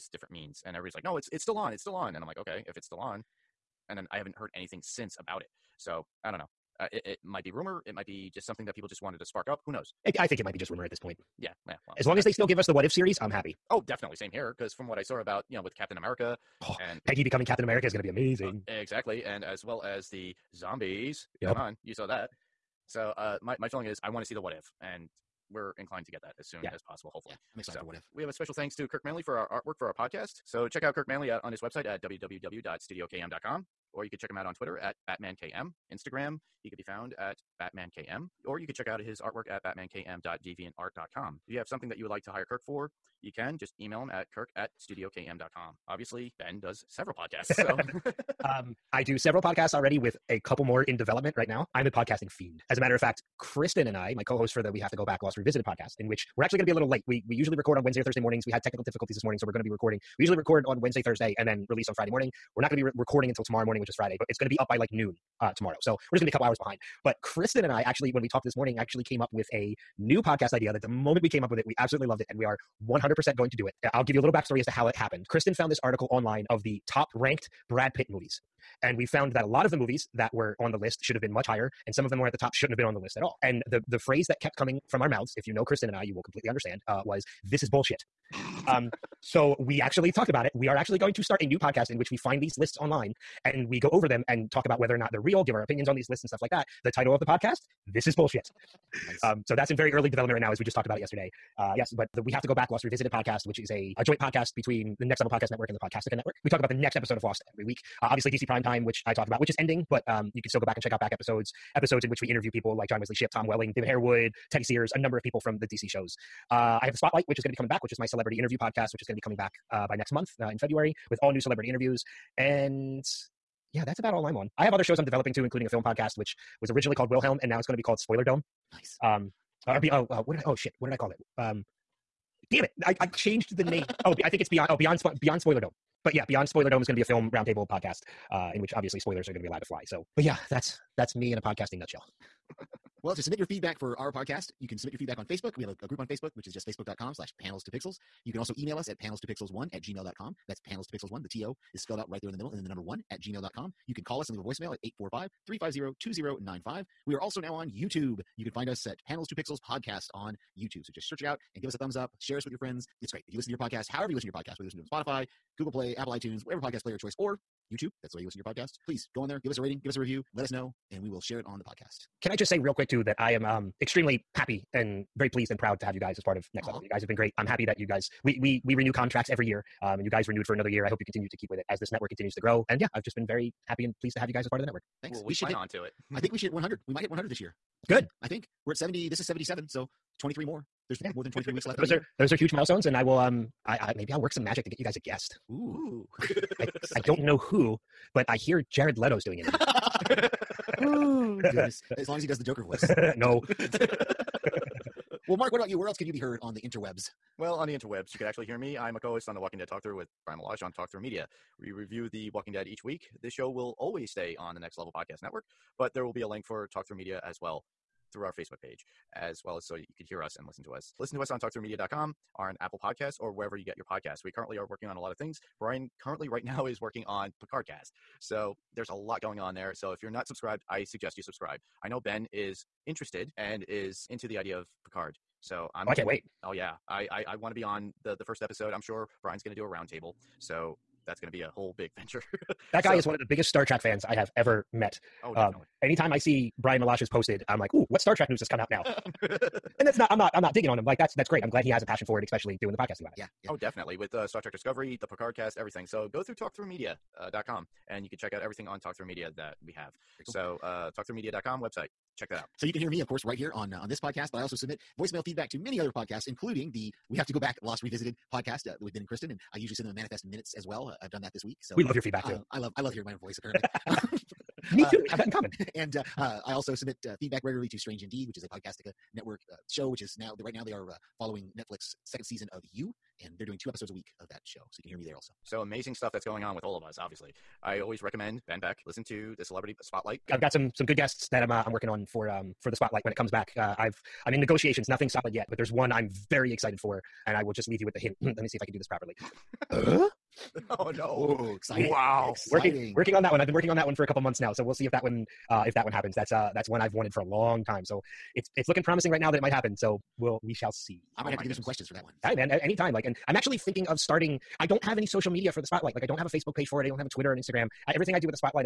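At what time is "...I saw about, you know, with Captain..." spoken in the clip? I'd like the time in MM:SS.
00:14.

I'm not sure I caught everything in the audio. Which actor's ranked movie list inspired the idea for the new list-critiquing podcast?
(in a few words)
Brad Pitt.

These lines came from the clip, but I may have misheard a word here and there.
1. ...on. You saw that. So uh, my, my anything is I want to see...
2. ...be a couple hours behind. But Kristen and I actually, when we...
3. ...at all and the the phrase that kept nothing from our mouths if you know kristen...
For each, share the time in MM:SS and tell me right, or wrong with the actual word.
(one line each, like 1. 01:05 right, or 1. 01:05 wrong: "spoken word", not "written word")
1. 00:21 wrong: "feeling", not "anything"
2. 01:06 right
3. 01:23 wrong: "coming", not "nothing".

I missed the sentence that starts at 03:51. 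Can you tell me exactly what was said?
I know Ben is interested and is into the idea of Picard.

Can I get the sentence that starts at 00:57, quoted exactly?
We, we usually record on Wednesday or Thursday mornings.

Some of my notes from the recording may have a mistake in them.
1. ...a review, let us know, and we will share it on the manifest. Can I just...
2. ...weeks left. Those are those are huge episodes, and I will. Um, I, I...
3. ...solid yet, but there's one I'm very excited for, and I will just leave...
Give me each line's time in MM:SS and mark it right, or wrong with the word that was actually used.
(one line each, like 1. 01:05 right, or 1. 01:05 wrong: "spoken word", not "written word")
1. 02:49 wrong: "podcast", not "manifest"
2. 03:11 wrong: "milestones", not "episodes"
3. 04:55 right.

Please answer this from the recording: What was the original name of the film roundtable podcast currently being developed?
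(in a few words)
Wilhelm.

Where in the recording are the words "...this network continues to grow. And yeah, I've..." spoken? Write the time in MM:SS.
03:01.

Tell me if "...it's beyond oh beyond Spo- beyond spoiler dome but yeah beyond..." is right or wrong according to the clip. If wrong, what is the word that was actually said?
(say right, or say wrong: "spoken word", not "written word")
right.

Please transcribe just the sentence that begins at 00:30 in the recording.
So check out Kirk Manley at, on his website at www.studiokm.com, or you could check him out on Twitter at BatmanKM, Instagram.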